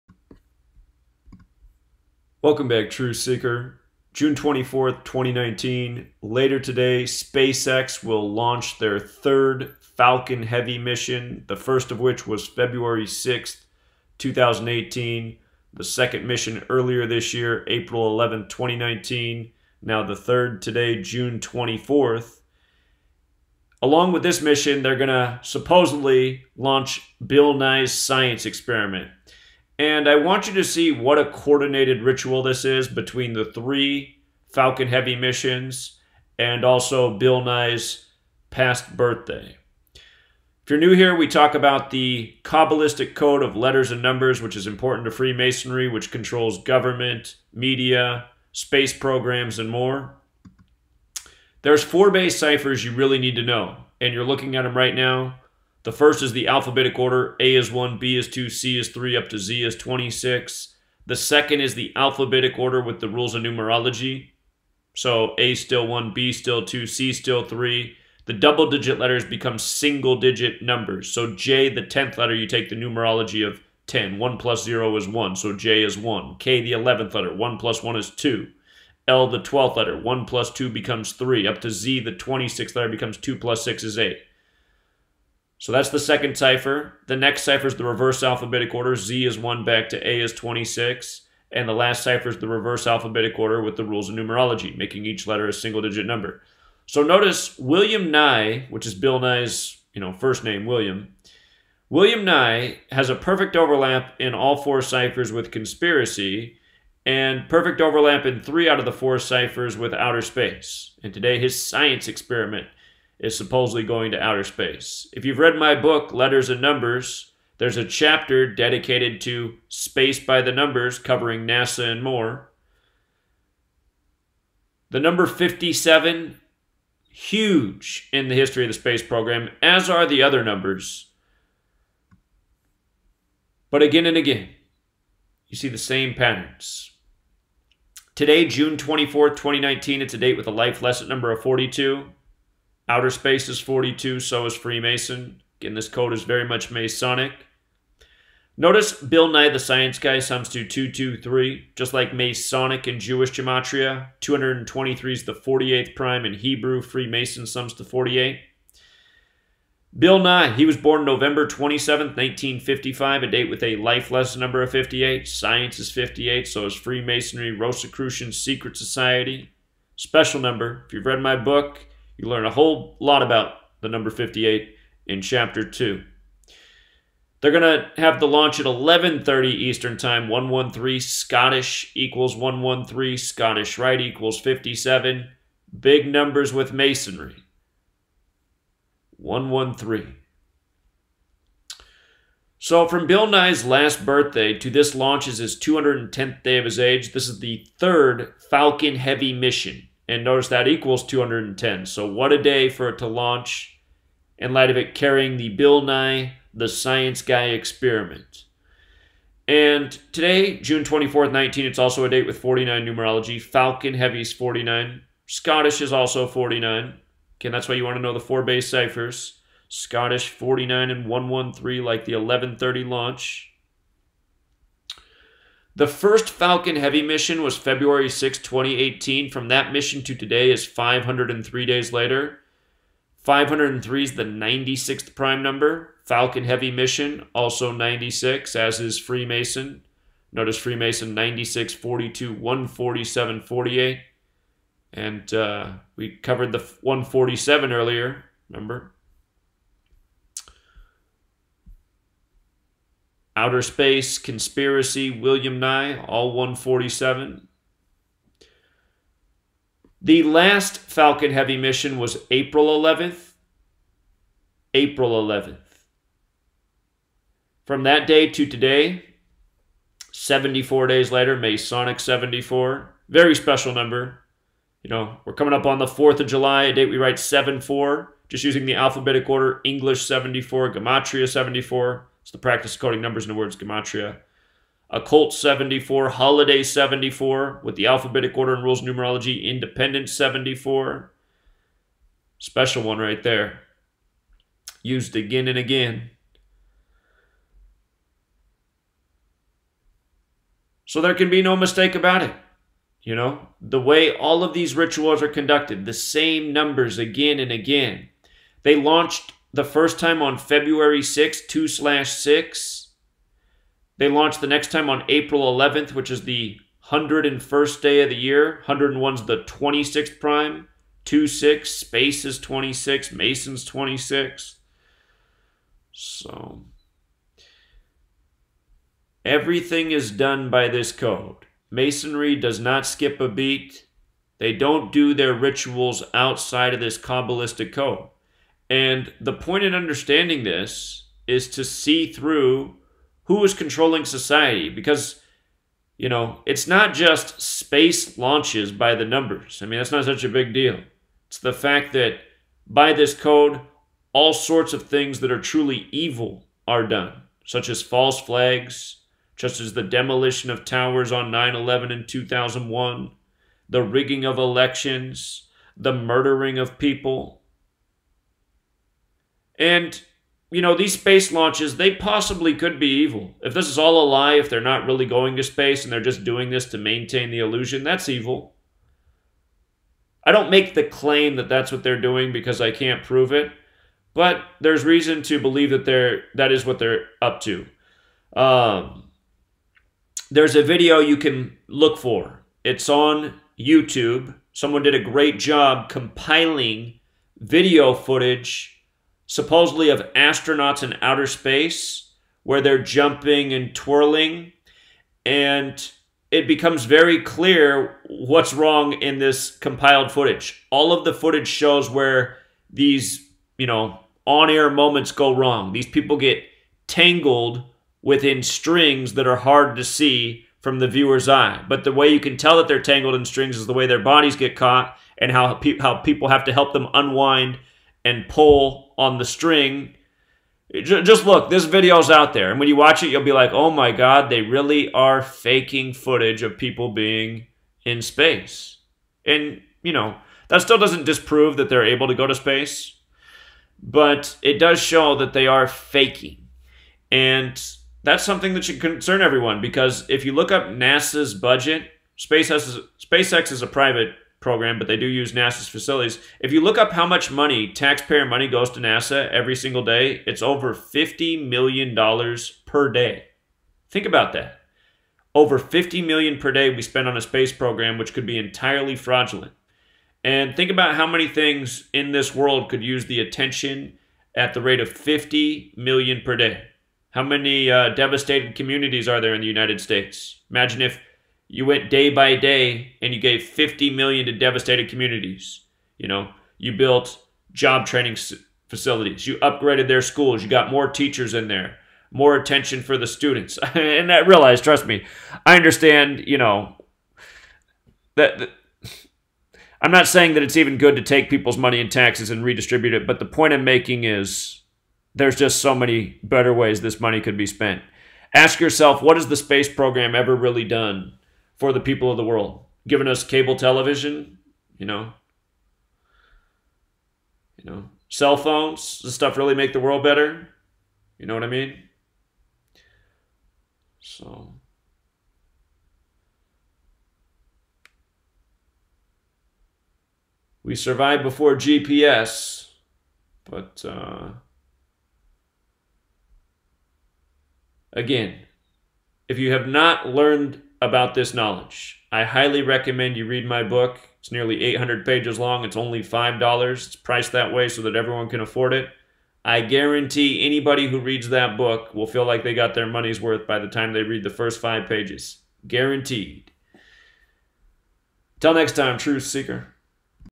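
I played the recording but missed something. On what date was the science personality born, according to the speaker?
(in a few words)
November 27, 1955.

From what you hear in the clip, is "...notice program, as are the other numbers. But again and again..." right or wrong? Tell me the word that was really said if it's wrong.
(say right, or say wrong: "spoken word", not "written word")
wrong: "space", not "notice".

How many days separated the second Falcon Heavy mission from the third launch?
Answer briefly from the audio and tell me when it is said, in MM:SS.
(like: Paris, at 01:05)
74, at 04:30.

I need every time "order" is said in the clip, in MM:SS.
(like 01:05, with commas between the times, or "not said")
00:56, 01:02, 01:28, 01:33, 04:39, 04:48.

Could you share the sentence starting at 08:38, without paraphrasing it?
Does stuff really make the world better?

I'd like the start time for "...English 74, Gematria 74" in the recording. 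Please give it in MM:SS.
04:39.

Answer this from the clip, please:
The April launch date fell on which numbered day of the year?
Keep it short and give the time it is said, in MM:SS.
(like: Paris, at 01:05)
101st, at 05:16.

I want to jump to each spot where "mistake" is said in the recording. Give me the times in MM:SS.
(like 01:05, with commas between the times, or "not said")
05:01.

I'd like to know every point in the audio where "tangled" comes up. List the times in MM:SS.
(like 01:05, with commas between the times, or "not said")
06:56, 07:02.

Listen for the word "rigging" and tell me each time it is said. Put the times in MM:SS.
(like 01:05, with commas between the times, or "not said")
06:03.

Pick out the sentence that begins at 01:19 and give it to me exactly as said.
L, the 12th letter, 1 plus 2 becomes 3.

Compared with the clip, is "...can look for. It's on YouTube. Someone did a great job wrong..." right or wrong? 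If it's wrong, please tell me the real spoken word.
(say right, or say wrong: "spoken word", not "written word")
wrong: "compiling", not "wrong".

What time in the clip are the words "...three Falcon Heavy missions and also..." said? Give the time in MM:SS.
00:33.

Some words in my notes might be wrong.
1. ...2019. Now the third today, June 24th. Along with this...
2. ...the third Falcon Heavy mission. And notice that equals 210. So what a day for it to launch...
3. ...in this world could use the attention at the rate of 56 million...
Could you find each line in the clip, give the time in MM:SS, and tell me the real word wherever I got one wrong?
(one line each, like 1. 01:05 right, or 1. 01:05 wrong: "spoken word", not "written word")
1. 00:18 right
2. 03:17 right
3. 07:51 wrong: "50", not "56".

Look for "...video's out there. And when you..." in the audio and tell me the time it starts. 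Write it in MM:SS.
07:11.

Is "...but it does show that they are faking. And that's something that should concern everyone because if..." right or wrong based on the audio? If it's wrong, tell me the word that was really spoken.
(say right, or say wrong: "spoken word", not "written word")
right.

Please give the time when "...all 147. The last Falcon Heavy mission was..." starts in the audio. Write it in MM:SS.
04:16.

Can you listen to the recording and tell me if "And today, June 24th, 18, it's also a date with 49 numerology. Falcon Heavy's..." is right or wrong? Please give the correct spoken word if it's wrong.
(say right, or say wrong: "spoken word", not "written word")
wrong: "19", not "18".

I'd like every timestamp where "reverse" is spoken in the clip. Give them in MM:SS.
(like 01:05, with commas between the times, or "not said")
01:27, 01:32.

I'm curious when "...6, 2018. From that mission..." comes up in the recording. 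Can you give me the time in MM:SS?
03:48.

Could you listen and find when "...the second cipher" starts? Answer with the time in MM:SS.
01:25.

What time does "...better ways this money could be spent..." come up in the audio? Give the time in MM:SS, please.
08:26.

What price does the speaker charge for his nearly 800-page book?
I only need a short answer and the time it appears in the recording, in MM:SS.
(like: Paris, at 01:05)
$5, at 09:06.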